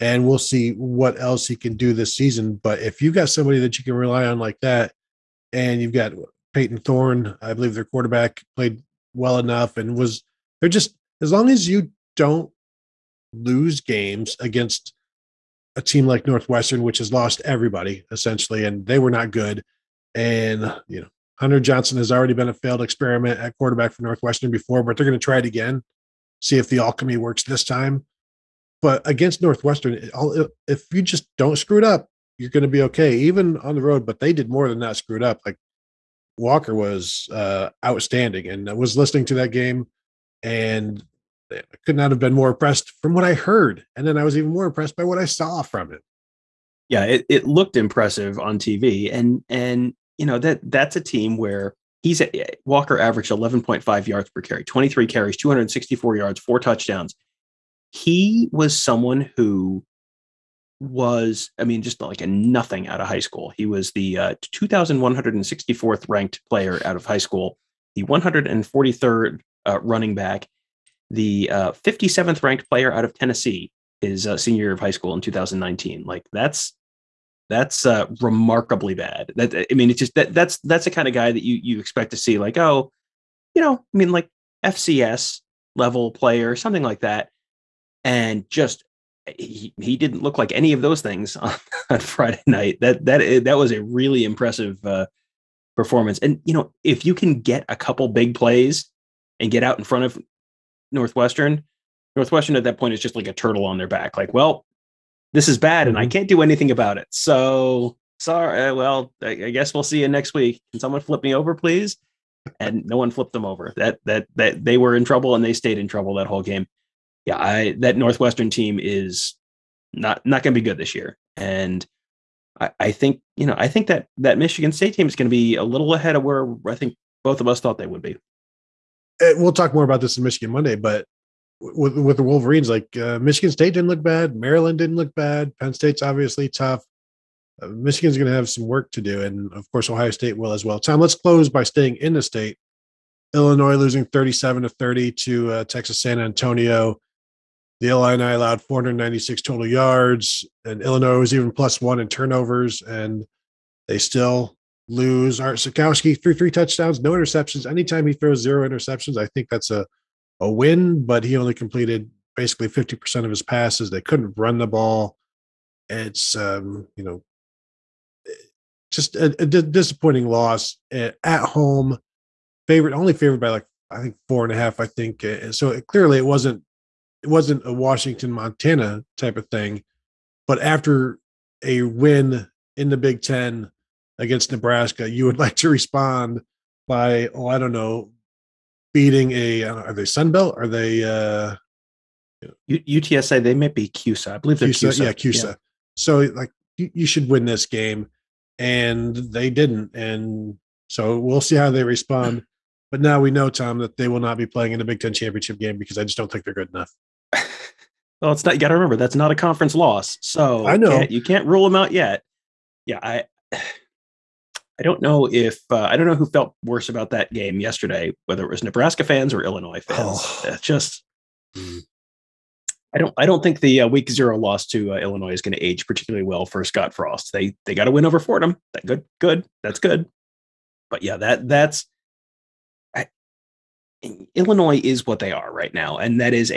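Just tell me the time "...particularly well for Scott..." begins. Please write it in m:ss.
3:45.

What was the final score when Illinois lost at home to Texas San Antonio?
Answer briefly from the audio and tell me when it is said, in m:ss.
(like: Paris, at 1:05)
37 to 30, at 2:24.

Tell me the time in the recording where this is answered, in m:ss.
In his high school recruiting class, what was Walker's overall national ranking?
1:04.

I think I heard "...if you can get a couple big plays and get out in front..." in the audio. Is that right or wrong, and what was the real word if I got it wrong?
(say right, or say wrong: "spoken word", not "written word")
right.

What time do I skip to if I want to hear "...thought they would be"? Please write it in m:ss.
2:07.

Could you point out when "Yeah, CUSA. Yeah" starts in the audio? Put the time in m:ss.
3:15.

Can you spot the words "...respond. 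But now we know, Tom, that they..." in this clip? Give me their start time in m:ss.
3:21.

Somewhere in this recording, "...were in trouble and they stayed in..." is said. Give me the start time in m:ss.
1:54.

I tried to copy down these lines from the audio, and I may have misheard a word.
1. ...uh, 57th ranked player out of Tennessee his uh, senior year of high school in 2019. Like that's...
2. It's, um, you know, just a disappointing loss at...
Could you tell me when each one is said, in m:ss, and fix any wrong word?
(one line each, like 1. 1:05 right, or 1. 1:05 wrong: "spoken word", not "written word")
1. 1:11 right
2. 2:45 right.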